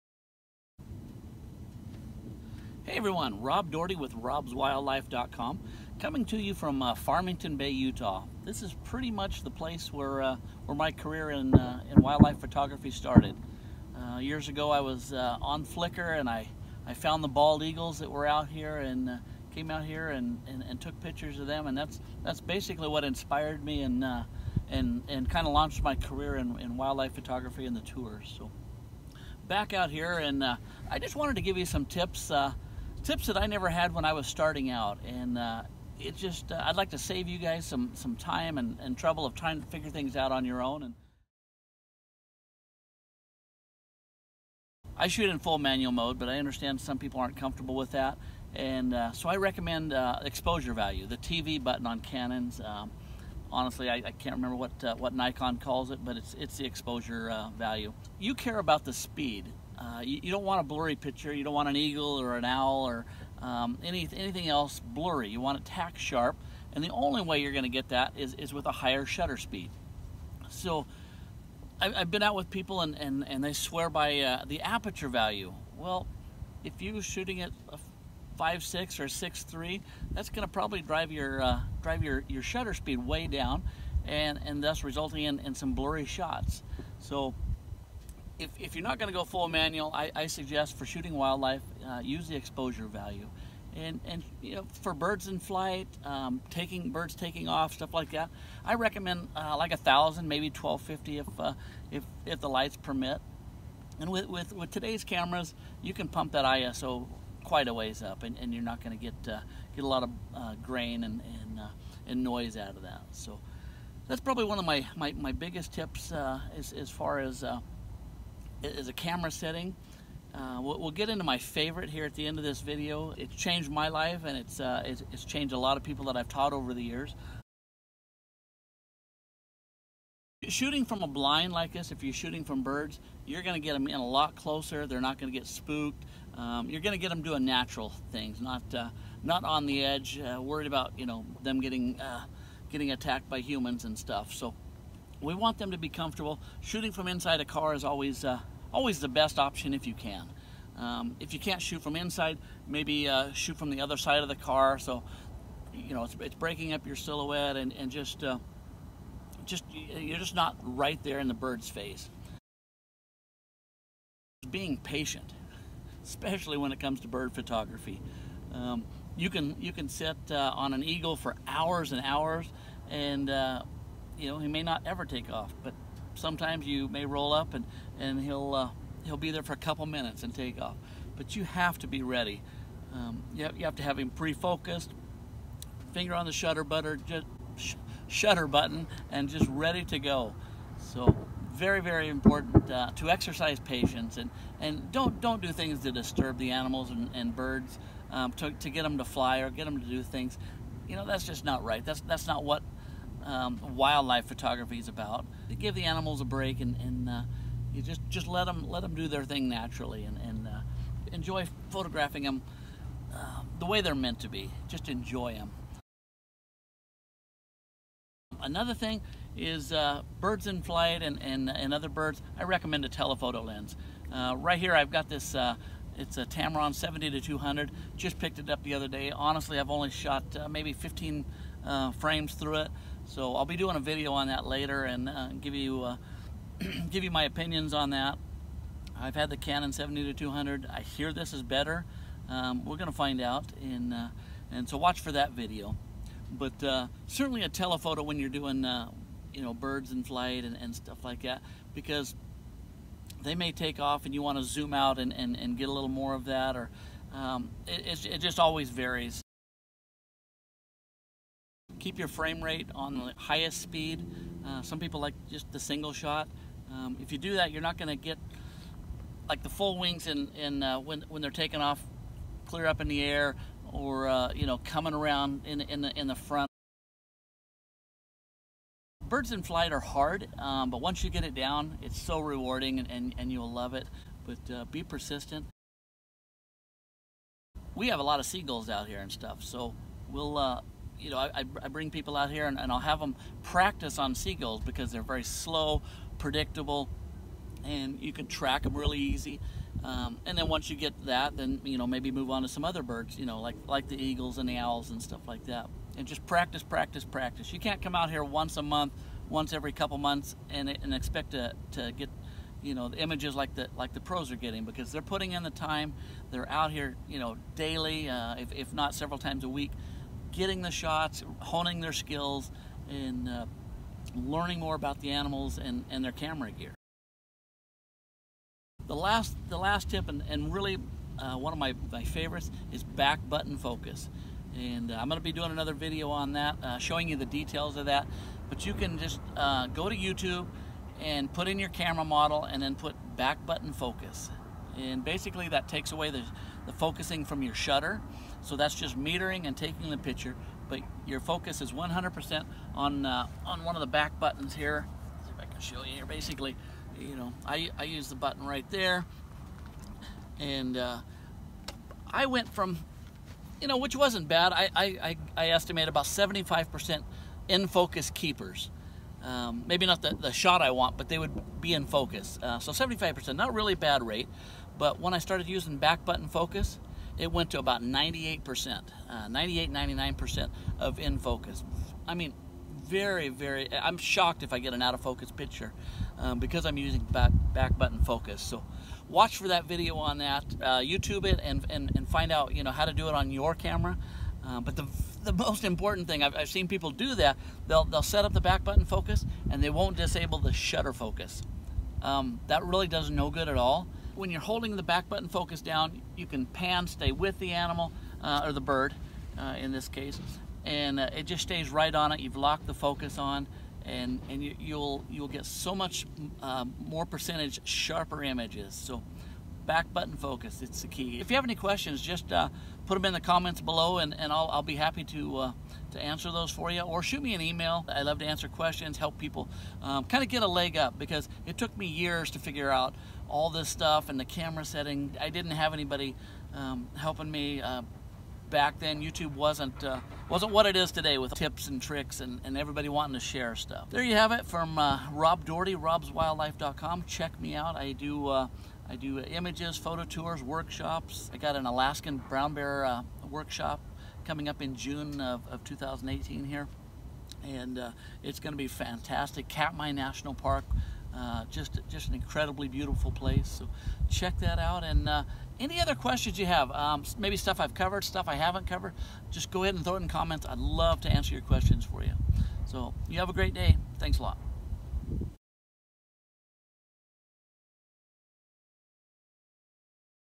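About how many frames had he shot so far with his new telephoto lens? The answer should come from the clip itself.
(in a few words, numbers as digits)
15.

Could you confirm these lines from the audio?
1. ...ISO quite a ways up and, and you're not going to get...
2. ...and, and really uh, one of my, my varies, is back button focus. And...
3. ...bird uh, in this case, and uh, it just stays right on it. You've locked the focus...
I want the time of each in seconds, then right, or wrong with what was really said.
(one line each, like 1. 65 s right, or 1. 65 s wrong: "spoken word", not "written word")
1. 106 s right
2. 330 s wrong: "favorites", not "varies"
3. 408 s right.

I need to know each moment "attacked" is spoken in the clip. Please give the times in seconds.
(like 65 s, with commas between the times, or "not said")
142 s.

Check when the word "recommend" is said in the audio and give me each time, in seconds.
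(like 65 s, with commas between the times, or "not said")
49 s, 98 s, 222 s.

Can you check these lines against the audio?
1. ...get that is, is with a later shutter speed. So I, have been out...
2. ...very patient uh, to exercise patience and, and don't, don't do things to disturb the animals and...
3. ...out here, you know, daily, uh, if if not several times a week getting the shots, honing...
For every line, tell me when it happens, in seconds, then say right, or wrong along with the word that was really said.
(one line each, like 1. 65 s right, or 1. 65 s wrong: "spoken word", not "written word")
1. 67 s wrong: "higher", not "later"
2. 191 s wrong: "important", not "patient"
3. 316 s right.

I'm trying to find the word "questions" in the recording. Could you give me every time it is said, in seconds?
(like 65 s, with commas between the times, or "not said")
421 s, 428 s, 465 s, 471 s.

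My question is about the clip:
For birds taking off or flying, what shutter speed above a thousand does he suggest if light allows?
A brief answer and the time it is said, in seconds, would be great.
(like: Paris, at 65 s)
1250, at 100 s.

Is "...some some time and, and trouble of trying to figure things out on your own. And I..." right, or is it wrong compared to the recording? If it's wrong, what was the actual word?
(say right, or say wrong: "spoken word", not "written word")
right.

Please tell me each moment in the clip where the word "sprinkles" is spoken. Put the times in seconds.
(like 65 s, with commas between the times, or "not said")
not said.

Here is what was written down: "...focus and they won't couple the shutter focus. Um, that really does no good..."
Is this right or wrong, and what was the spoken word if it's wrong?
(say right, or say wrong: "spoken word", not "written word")
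wrong: "disable", not "couple".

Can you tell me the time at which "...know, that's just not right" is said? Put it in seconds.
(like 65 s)
200 s.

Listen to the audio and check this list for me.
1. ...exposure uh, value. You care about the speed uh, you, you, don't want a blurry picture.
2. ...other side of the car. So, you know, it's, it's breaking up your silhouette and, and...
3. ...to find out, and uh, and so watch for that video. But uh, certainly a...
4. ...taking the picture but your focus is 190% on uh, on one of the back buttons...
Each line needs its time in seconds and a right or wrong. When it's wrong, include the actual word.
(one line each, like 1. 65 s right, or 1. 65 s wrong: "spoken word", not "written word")
1. 56 s right
2. 153 s right
3. 242 s right
4. 349 s wrong: "100", not "190".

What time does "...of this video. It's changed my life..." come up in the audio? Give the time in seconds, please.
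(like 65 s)
122 s.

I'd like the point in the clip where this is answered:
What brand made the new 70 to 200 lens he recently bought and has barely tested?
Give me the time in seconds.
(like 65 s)
226 s.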